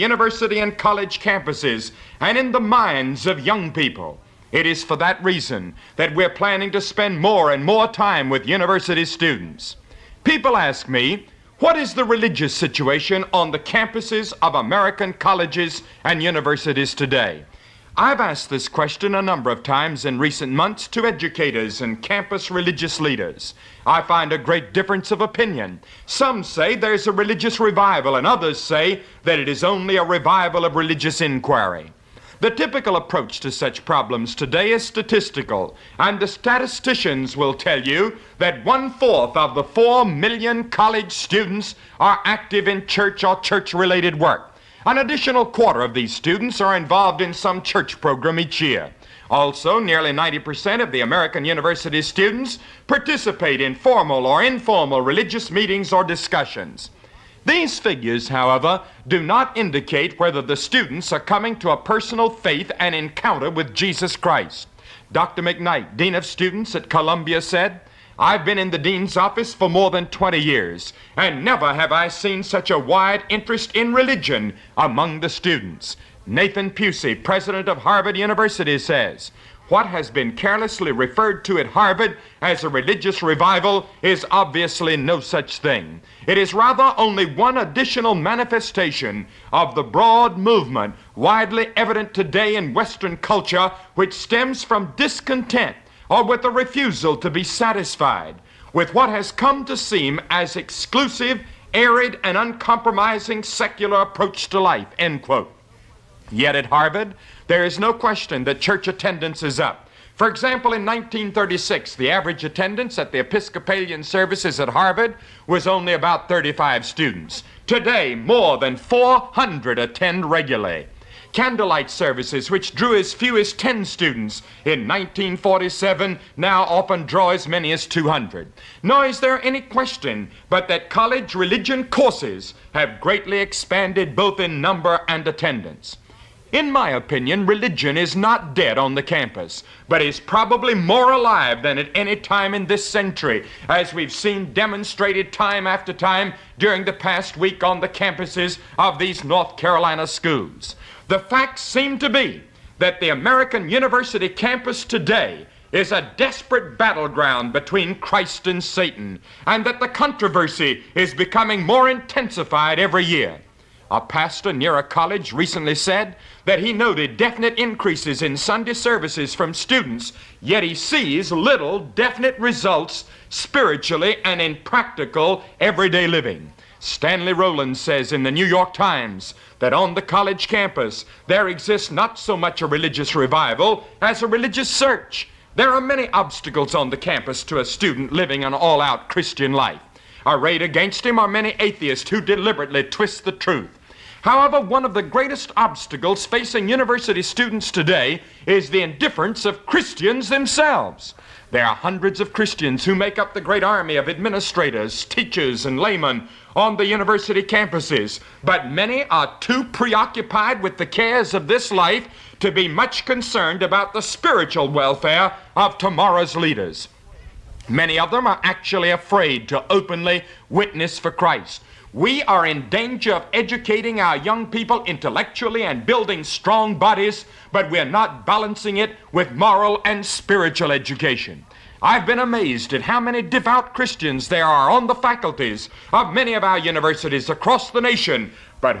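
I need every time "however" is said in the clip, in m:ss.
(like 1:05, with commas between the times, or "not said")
0:58, 3:14.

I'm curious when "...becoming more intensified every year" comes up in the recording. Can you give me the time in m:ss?
2:41.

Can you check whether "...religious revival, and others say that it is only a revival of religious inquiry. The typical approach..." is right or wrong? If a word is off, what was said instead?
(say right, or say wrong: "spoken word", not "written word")
right.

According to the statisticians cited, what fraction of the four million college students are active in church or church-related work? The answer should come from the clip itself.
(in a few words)
one fourth.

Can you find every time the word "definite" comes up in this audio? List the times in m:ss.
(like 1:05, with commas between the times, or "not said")
2:47, 2:51.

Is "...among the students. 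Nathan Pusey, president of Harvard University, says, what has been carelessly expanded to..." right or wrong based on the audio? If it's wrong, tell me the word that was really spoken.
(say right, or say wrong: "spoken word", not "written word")
wrong: "referred", not "expanded".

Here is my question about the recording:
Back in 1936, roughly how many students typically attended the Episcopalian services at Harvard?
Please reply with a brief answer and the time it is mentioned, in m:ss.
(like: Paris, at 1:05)
35, at 1:56.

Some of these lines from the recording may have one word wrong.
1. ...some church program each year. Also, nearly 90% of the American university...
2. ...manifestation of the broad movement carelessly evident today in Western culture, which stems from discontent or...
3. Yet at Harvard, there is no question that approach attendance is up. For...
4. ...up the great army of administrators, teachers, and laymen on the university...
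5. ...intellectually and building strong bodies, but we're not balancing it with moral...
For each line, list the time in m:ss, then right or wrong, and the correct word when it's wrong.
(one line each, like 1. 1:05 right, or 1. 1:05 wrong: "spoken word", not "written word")
1. 0:47 right
2. 1:28 wrong: "widely", not "carelessly"
3. 1:46 wrong: "church", not "approach"
4. 3:23 right
5. 3:44 right.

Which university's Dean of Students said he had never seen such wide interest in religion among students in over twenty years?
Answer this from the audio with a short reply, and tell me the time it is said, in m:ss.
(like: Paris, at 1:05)
Columbia, at 1:06.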